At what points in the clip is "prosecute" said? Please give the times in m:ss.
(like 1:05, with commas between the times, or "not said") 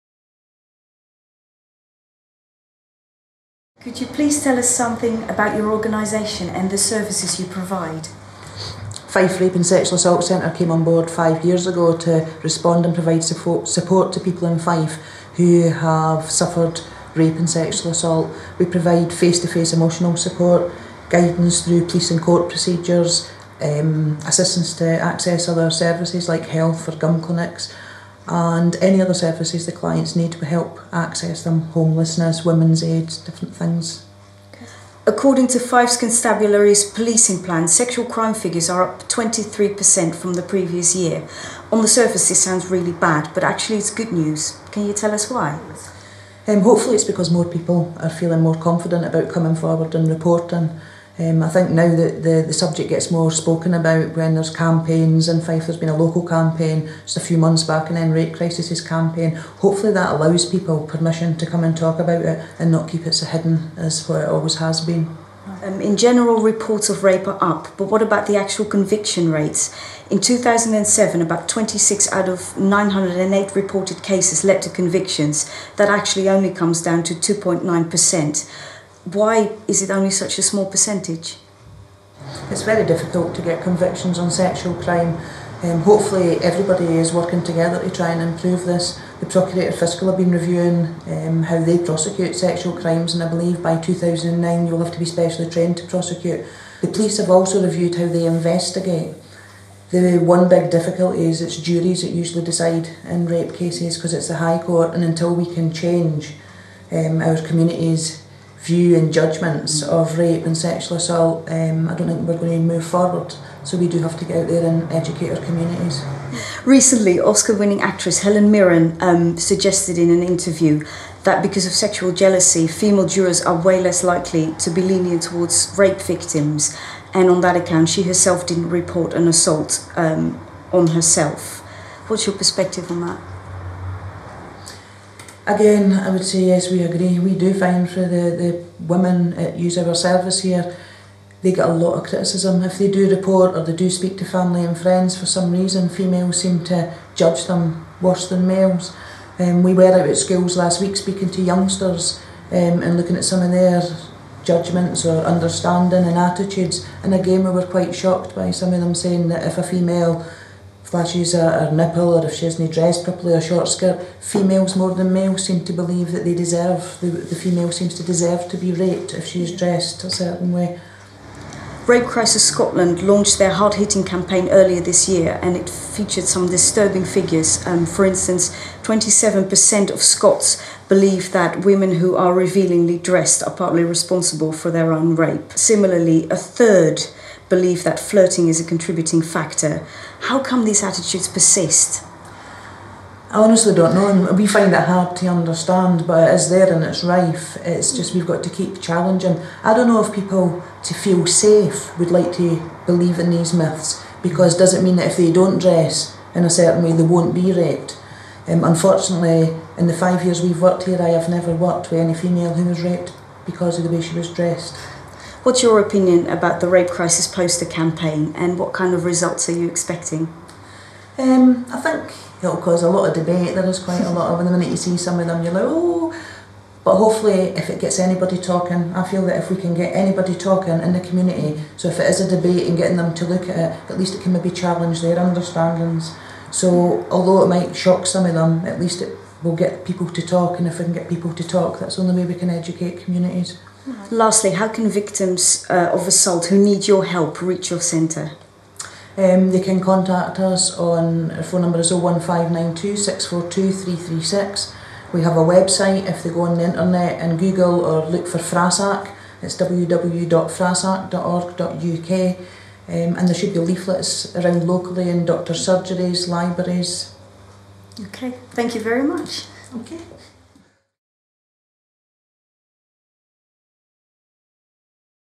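1:31, 1:35.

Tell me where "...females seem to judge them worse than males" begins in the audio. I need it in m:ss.
2:25.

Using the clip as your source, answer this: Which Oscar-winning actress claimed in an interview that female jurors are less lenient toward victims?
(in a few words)
Helen Mirren.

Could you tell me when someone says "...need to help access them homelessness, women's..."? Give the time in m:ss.
0:30.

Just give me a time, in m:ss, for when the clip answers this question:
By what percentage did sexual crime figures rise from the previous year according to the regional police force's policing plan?
0:39.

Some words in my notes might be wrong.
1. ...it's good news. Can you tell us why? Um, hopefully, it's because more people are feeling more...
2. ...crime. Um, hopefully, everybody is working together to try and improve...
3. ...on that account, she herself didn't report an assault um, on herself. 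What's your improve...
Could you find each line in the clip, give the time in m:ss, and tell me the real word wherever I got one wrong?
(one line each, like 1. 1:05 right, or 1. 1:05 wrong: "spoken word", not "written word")
1. 0:43 right
2. 1:24 right
3. 2:07 wrong: "perspective", not "improve".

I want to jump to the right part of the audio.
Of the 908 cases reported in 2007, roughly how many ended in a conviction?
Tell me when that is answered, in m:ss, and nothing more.
1:11.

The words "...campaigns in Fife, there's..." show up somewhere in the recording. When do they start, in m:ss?
0:54.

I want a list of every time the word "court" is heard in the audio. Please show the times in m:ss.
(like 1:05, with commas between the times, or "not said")
0:22, 1:44.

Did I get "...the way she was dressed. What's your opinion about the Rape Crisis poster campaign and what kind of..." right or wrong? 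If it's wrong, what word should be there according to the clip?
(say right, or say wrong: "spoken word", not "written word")
right.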